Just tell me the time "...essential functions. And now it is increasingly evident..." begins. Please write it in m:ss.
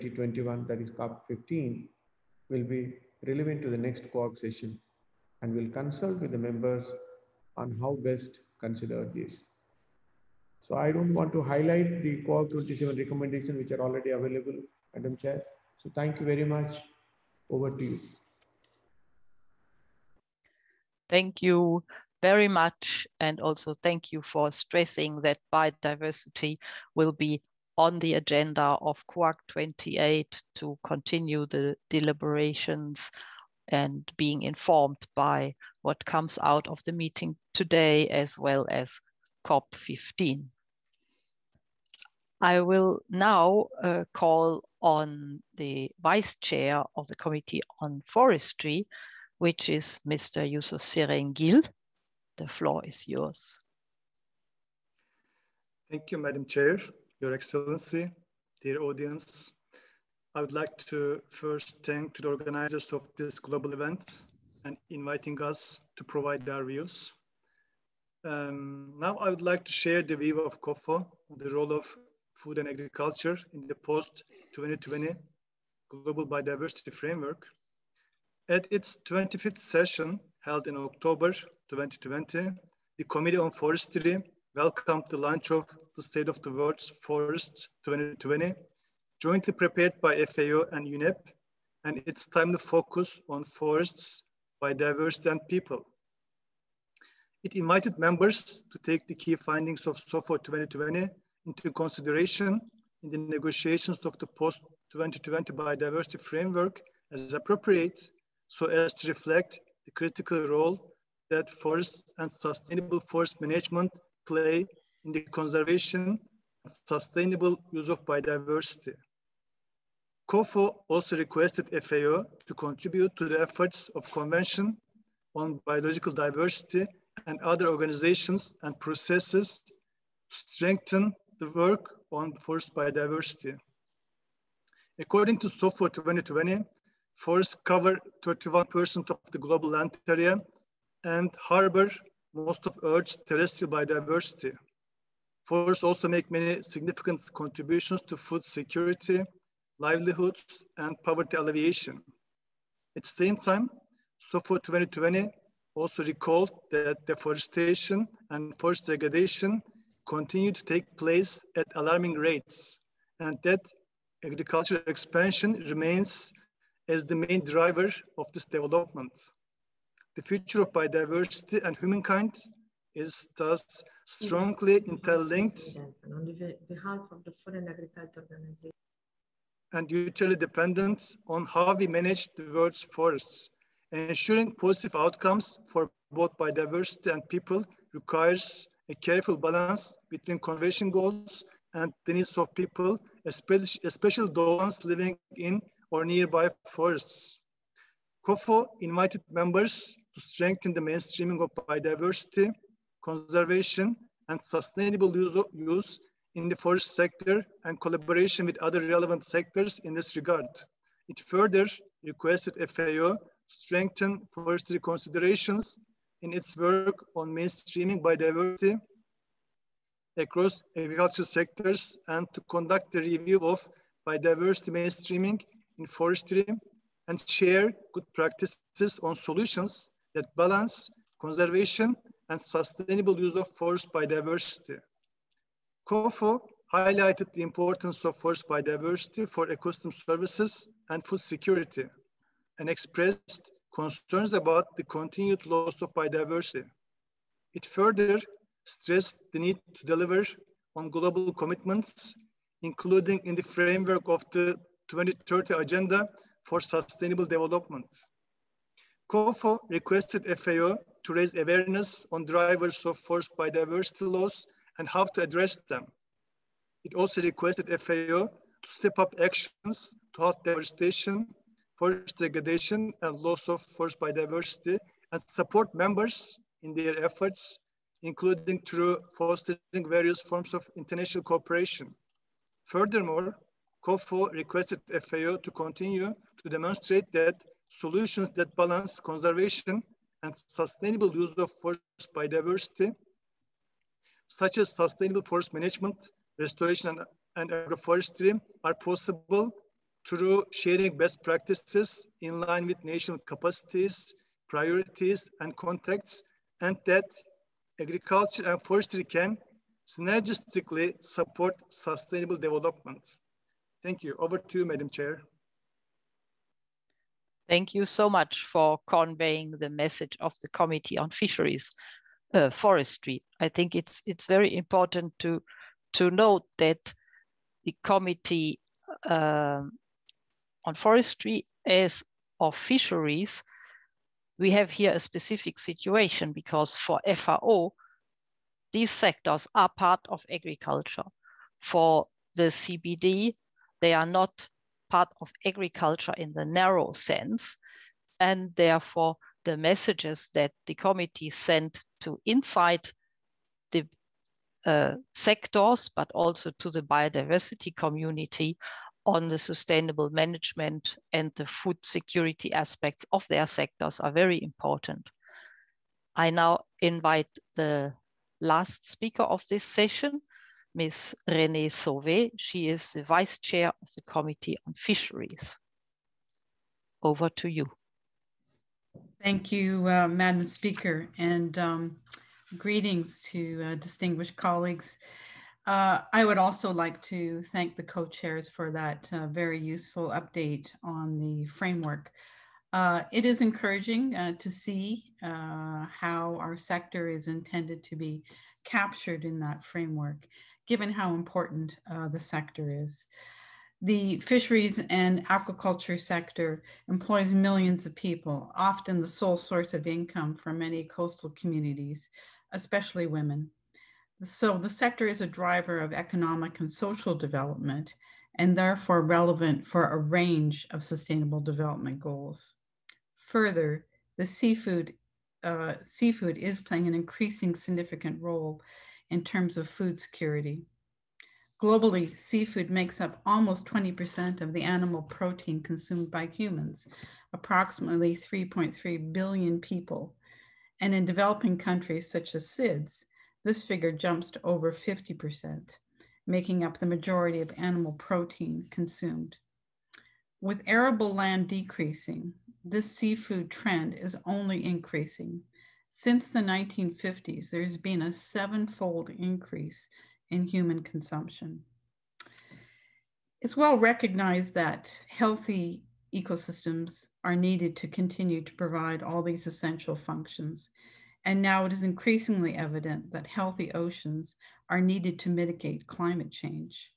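7:49.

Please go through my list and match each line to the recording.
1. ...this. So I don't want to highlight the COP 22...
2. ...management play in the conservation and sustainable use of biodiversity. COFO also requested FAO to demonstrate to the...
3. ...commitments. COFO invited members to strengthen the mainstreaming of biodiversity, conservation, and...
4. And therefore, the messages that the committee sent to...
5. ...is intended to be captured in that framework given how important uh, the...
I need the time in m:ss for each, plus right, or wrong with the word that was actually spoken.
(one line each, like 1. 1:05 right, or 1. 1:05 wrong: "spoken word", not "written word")
1. 0:09 wrong: "27", not "22"
2. 1:53 wrong: "contribute", not "demonstrate"
3. 3:16 wrong: "forests", not "commitments"
4. 5:48 right
5. 6:37 right.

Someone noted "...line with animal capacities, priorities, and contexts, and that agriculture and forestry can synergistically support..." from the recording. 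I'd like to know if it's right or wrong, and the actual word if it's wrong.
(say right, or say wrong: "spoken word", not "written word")
wrong: "national", not "animal".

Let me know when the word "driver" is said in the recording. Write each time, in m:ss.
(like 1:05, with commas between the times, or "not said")
2:47, 4:22, 6:55.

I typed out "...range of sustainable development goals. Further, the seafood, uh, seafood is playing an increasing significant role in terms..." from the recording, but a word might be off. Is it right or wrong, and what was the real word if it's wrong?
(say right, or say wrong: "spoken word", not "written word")
right.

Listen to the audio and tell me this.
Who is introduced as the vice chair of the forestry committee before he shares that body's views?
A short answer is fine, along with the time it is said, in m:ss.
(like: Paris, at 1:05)
Yusuf Serengil, at 0:50.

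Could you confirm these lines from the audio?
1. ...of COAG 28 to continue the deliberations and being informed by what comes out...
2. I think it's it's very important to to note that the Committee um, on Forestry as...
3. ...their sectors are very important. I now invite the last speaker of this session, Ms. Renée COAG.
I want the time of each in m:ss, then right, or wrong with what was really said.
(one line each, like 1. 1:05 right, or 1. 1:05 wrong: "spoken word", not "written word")
1. 0:28 right
2. 5:23 right
3. 6:03 wrong: "Sauvé", not "COAG".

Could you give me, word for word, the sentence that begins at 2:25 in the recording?
Forests also make many significant contributions to food security, livelihoods, and poverty alleviation.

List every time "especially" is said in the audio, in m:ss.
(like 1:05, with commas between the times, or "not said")
3:13, 6:52.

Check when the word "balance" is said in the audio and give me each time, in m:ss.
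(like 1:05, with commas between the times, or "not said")
3:09, 3:50, 4:48.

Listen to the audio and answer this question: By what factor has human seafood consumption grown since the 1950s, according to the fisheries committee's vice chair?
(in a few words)
sevenfold.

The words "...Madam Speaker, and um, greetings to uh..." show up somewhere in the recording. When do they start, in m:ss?
6:20.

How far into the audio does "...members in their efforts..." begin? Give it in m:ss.
4:35.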